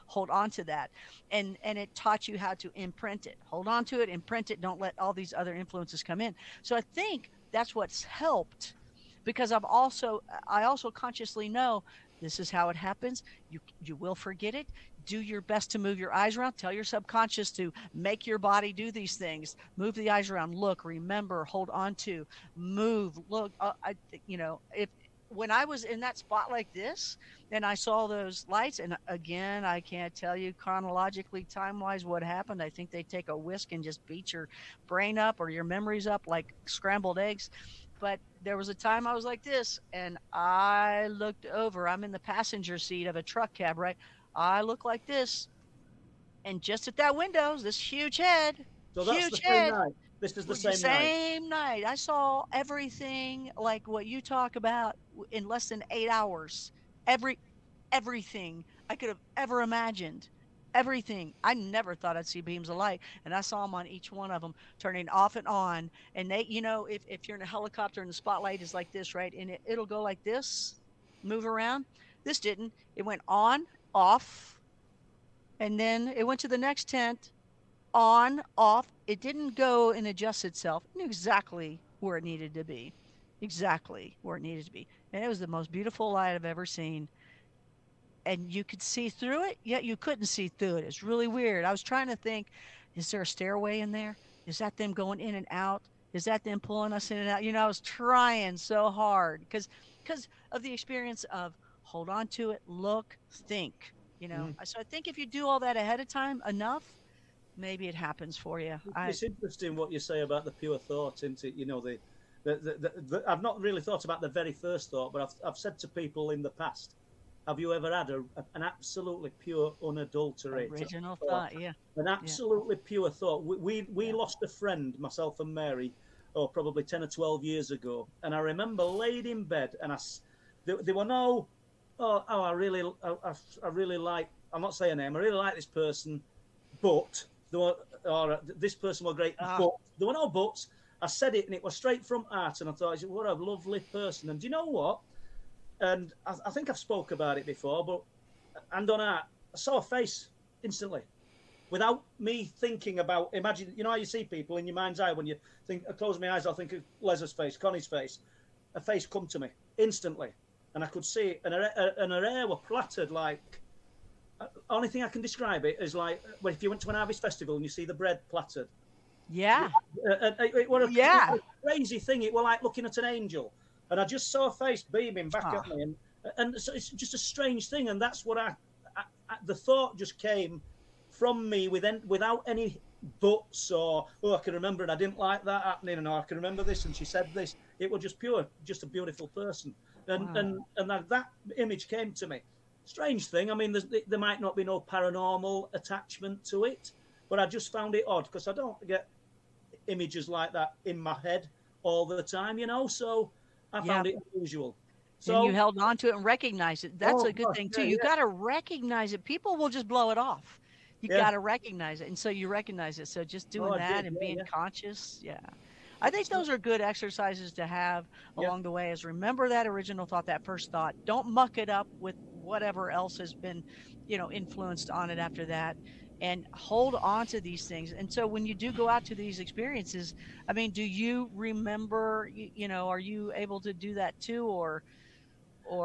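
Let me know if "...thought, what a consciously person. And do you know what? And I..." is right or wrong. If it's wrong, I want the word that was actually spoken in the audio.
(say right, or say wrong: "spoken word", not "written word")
wrong: "lovely", not "consciously".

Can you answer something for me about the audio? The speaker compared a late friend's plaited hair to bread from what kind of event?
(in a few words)
Harvest festival.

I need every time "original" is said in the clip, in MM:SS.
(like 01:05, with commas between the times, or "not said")
02:00, 03:39.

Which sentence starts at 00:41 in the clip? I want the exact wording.
I'm in the passenger seat of a truck cab, right?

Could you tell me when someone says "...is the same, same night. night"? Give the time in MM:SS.
00:50.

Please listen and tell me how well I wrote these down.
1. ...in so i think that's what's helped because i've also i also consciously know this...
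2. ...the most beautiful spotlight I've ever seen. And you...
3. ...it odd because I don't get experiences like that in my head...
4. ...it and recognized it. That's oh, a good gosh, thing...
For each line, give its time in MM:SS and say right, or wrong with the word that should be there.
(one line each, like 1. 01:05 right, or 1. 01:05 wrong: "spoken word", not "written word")
1. 00:06 right
2. 01:25 wrong: "light", not "spotlight"
3. 03:17 wrong: "images", not "experiences"
4. 03:26 right.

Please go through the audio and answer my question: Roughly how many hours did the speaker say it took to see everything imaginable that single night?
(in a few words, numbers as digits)
8 hours.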